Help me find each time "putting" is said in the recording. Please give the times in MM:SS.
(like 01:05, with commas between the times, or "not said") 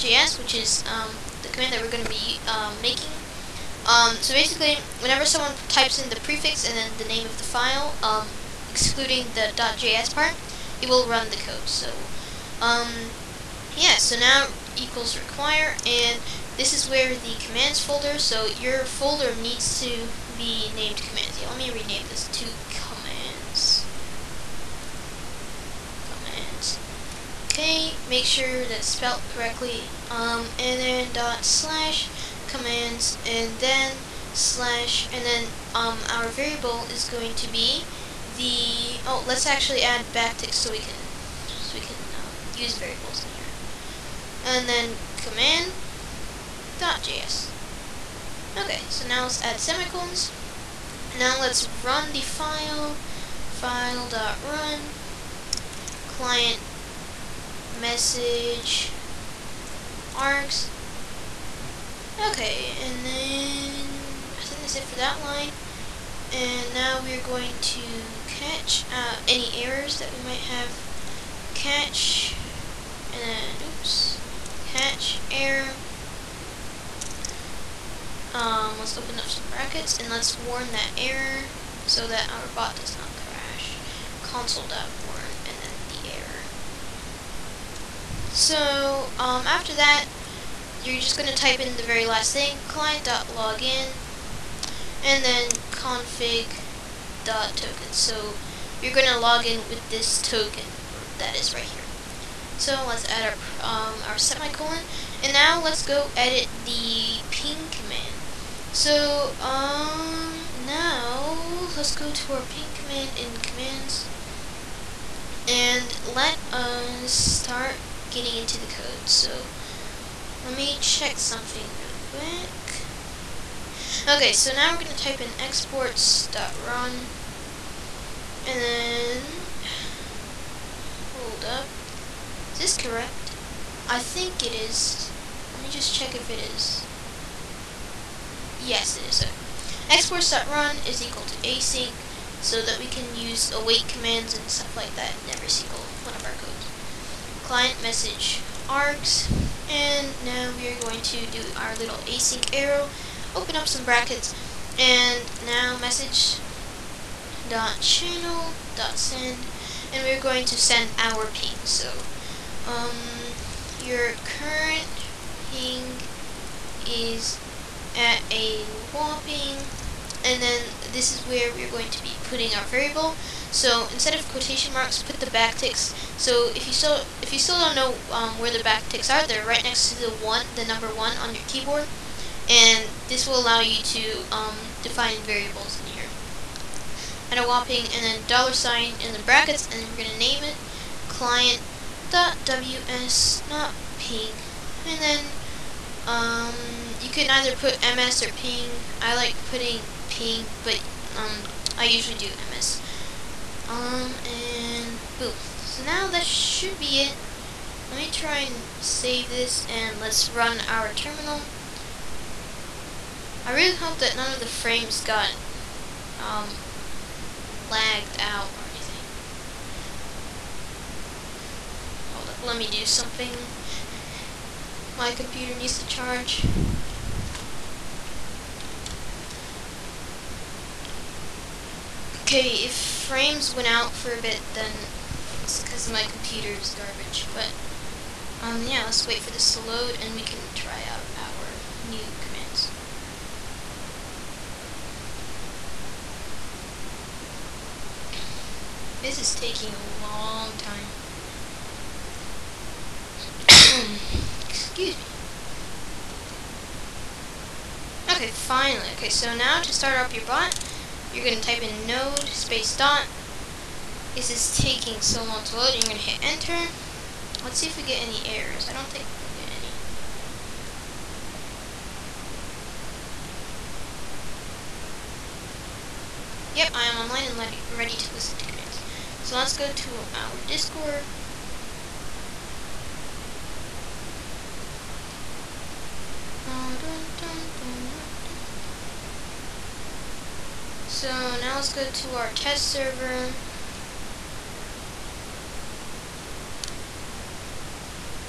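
02:52, 03:19.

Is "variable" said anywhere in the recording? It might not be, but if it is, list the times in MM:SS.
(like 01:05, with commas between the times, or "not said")
00:36, 00:42, 02:52, 03:05.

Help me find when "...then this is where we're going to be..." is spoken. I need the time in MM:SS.
02:50.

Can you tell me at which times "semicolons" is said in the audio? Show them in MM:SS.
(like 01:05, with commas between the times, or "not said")
00:49, 01:44.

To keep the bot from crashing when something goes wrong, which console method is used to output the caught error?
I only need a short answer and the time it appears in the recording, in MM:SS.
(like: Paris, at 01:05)
console.warn, at 01:24.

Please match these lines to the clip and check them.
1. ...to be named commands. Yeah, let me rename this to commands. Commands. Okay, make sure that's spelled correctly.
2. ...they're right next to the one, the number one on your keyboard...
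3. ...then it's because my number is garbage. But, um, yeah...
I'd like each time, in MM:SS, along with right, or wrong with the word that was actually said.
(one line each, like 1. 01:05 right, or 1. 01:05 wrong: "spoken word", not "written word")
1. 00:19 right
2. 02:59 right
3. 03:54 wrong: "computer", not "number".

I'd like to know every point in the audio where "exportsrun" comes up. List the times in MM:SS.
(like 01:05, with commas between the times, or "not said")
02:05, 02:19.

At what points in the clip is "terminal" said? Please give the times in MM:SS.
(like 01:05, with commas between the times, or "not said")
03:30.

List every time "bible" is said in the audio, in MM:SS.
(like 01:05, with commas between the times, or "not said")
not said.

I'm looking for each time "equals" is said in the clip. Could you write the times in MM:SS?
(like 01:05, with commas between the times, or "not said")
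00:14, 02:21.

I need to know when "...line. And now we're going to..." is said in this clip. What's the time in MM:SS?
01:05.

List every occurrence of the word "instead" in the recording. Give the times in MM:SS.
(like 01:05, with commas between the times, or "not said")
02:53.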